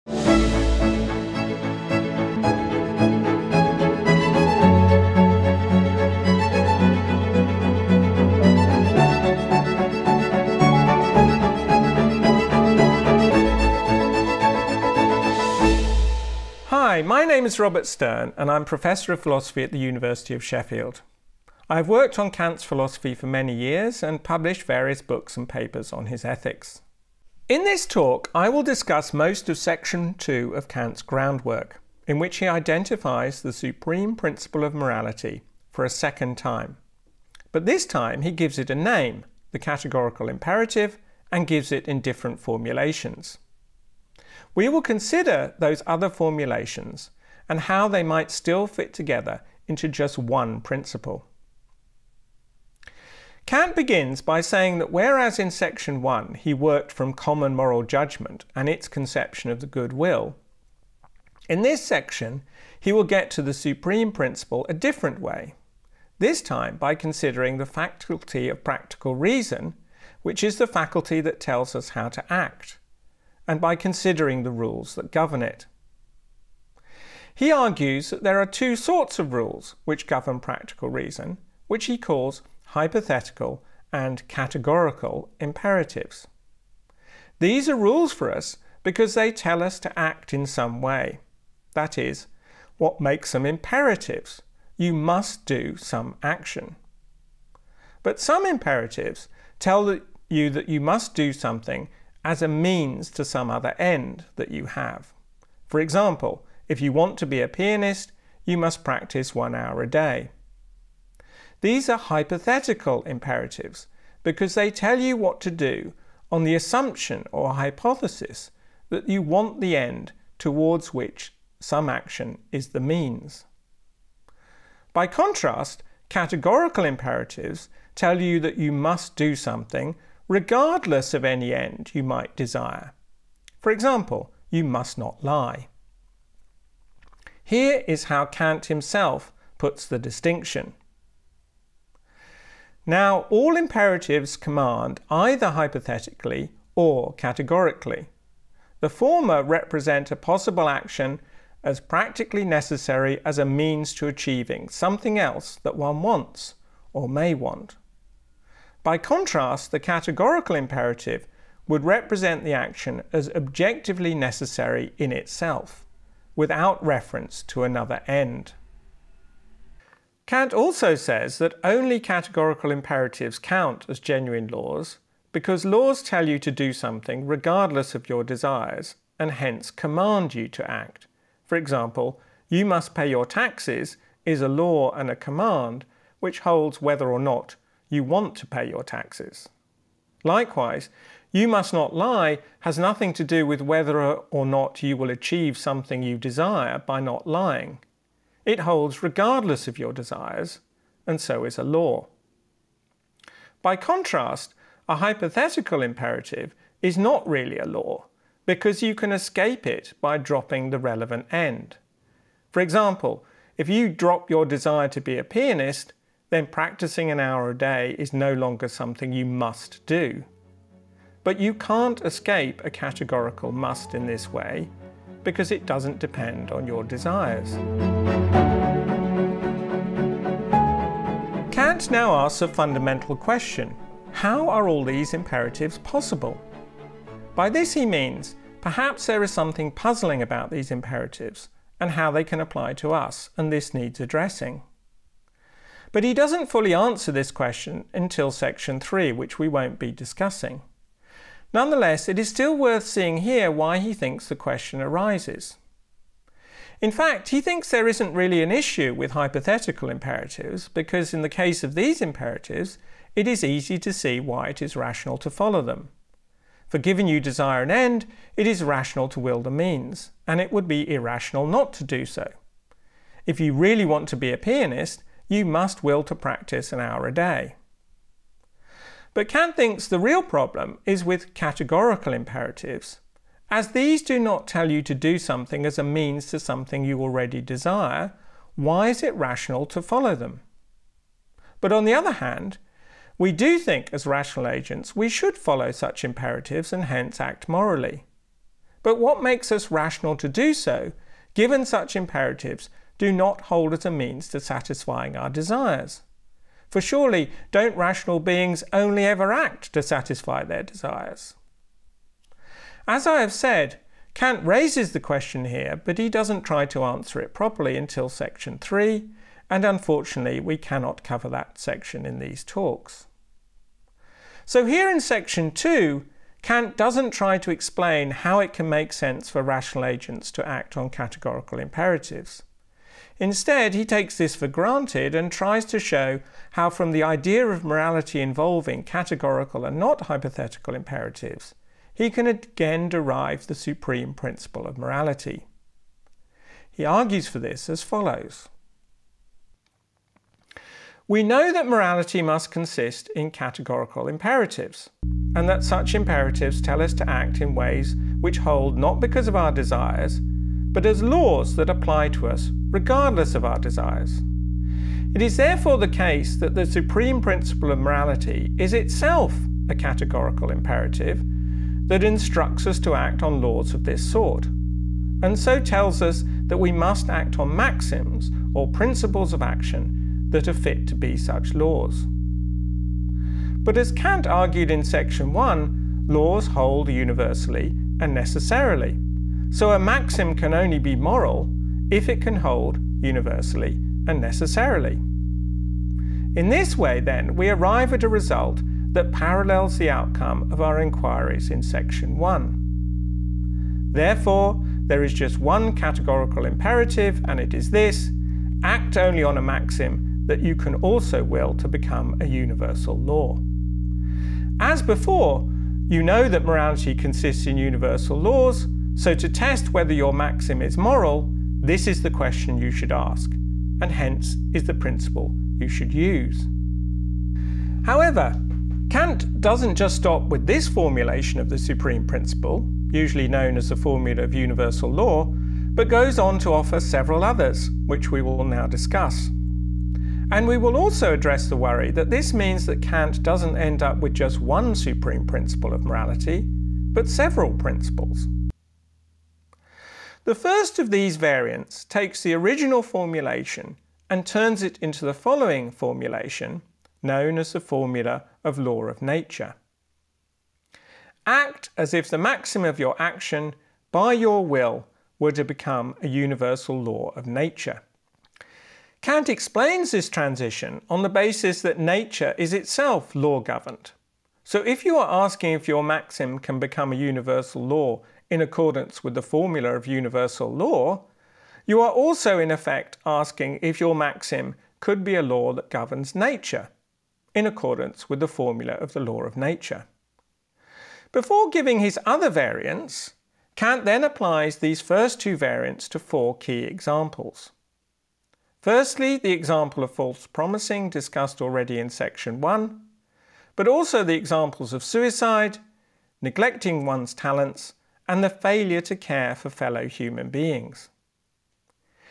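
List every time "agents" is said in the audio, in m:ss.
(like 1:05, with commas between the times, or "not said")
4:54, 5:29.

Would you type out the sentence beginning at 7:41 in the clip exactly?
Act as if the maxim of your action, by your will, were to become a universal law of nature.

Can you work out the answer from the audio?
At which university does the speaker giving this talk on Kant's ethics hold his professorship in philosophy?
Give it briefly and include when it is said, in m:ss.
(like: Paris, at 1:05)
University of Sheffield, at 0:19.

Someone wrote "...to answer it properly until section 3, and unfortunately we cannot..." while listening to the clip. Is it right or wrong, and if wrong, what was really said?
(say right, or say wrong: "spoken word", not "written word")
right.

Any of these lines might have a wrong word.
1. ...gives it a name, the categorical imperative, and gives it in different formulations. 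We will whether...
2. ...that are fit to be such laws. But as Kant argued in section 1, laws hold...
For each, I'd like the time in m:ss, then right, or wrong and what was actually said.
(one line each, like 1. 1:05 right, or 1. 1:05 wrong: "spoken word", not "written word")
1. 0:38 wrong: "consider", not "whether"
2. 6:20 right.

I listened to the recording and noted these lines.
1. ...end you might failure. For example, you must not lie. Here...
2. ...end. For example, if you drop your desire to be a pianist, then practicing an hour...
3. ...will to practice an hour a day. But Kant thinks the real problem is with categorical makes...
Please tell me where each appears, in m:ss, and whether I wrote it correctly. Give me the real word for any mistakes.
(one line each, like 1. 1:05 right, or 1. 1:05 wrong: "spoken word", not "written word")
1. 2:11 wrong: "desire", not "failure"
2. 3:31 right
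3. 4:35 wrong: "imperatives", not "makes".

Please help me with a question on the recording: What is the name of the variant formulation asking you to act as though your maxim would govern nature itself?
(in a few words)
formula of law of nature.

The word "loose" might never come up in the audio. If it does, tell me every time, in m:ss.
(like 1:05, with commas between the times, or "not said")
not said.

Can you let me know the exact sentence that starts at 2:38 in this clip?
By contrast, the categorical imperative would represent the action as objectively necessary in itself without reference to another end.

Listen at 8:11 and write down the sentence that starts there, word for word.
Before giving his other variants, Kant then applies these first two variants to four key examples.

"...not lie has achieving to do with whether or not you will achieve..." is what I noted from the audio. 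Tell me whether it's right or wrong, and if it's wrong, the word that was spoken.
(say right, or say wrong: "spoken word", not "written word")
wrong: "nothing", not "achieving".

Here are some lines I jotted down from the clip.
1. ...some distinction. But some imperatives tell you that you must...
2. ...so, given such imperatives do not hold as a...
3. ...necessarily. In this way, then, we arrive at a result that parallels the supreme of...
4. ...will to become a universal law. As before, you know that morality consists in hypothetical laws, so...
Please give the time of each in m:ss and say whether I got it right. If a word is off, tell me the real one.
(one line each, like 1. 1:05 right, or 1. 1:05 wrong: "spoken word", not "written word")
1. 1:35 wrong: "action", not "distinction"
2. 5:00 right
3. 6:34 wrong: "outcome", not "supreme"
4. 6:51 wrong: "universal", not "hypothetical".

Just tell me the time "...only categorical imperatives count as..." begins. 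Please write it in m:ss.
2:51.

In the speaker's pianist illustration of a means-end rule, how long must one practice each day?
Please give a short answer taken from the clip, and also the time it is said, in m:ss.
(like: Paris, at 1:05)
1 hour, at 1:49.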